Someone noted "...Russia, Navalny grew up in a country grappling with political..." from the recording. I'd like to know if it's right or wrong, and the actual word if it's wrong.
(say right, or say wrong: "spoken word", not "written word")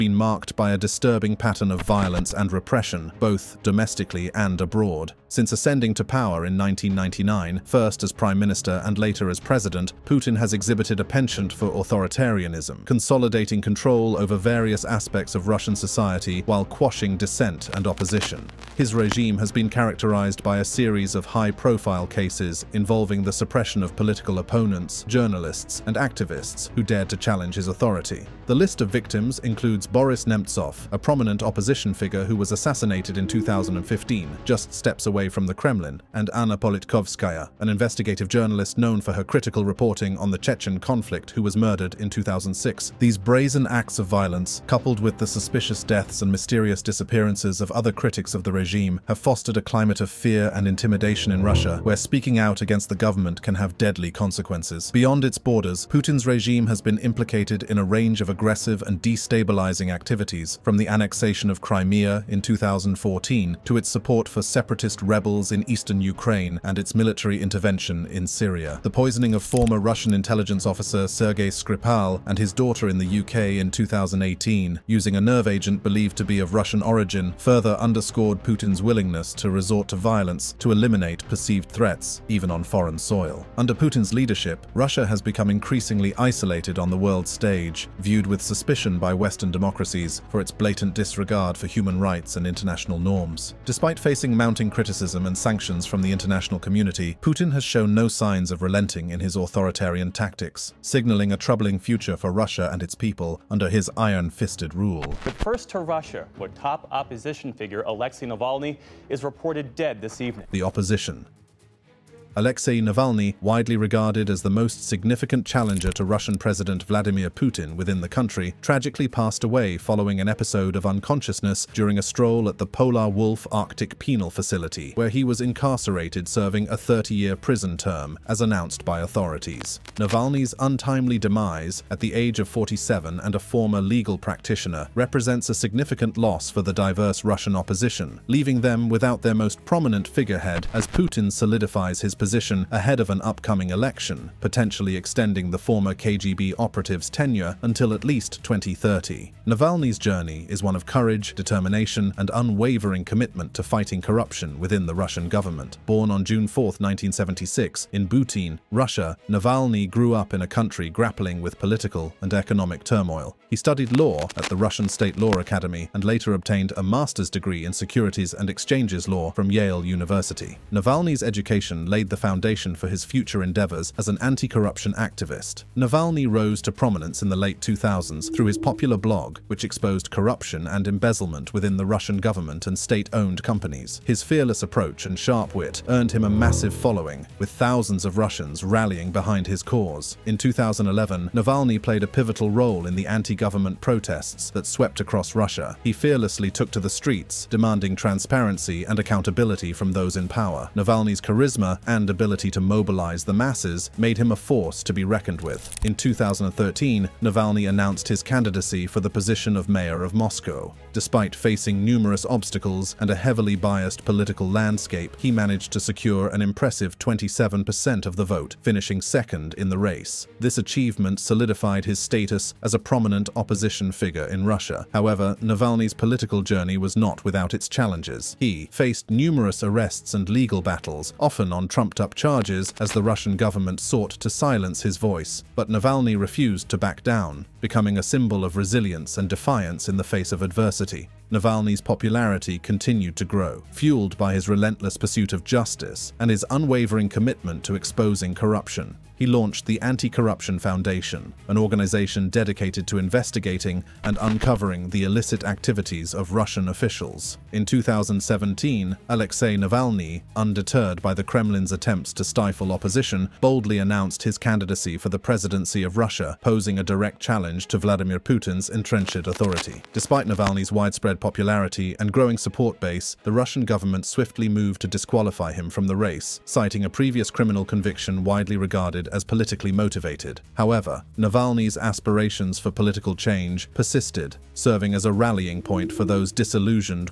right.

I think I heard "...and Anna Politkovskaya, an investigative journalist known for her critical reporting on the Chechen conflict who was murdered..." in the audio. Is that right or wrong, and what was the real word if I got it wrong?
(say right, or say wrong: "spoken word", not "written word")
right.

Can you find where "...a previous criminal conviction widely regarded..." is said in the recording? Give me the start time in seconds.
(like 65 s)
276 s.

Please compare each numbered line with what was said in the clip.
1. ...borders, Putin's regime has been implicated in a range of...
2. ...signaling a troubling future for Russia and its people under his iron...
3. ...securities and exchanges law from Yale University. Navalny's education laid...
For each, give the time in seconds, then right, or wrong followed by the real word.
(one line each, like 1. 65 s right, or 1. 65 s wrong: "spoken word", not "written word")
1. 55 s right
2. 100 s right
3. 167 s right.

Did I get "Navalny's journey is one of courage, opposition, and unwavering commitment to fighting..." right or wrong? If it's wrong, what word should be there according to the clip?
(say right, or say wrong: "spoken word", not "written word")
wrong: "determination", not "opposition".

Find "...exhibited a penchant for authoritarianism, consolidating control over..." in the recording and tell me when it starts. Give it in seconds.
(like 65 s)
10 s.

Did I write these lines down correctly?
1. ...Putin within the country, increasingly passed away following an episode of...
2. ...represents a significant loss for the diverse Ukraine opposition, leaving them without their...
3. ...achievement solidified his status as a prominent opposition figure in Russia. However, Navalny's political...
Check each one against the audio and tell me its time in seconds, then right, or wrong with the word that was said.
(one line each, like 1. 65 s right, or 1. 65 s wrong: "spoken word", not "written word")
1. 117 s wrong: "tragically", not "increasingly"
2. 134 s wrong: "Russian", not "Ukraine"
3. 220 s right.